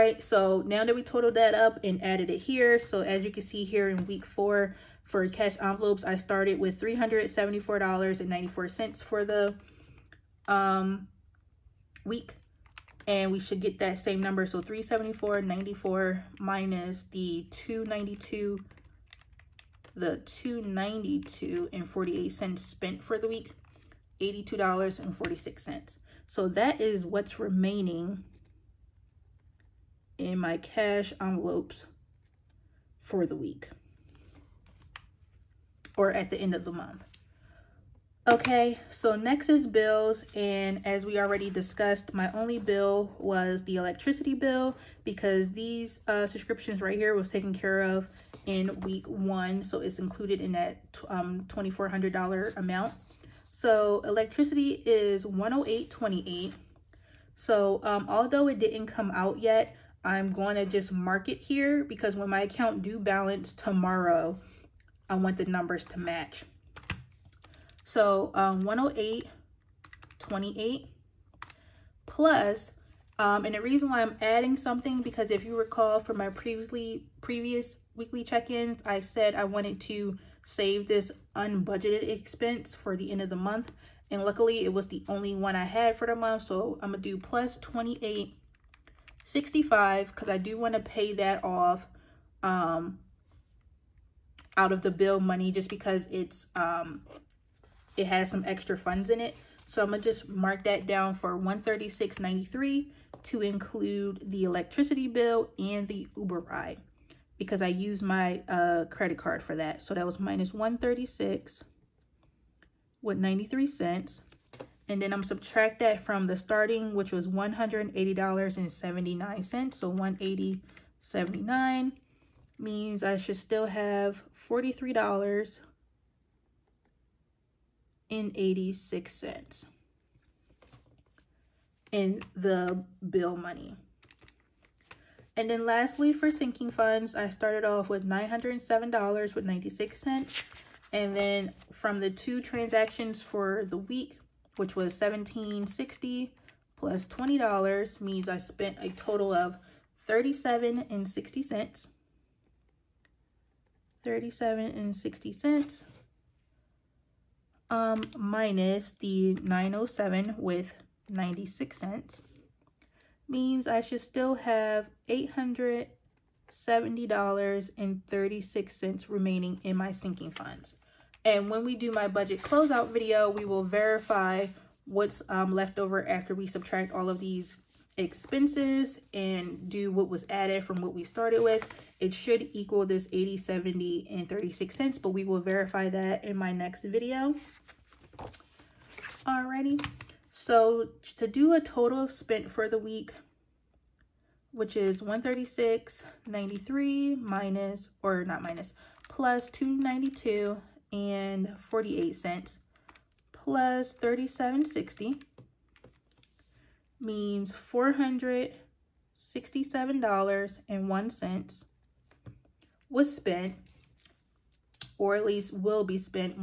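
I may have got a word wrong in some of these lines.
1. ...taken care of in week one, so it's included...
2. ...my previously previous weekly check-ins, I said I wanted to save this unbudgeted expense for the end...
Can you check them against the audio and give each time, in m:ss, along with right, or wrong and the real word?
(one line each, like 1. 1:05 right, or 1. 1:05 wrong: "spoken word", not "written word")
1. 0:47 right
2. 1:16 right.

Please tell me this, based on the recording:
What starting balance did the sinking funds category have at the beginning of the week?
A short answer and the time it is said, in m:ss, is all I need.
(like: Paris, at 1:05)
$907.96, at 2:18.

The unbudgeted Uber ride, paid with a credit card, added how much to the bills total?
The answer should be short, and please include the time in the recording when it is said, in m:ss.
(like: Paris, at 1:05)
$28.65, at 1:27.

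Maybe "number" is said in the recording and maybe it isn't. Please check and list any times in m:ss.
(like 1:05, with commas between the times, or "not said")
0:14, 1:05.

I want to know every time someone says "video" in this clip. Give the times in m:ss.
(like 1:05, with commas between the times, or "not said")
2:52, 3:06.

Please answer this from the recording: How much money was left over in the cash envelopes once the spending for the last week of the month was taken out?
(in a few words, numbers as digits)
$82.46.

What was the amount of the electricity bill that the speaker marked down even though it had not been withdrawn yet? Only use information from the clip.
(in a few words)
$108.28.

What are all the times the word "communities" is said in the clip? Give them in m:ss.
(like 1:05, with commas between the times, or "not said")
not said.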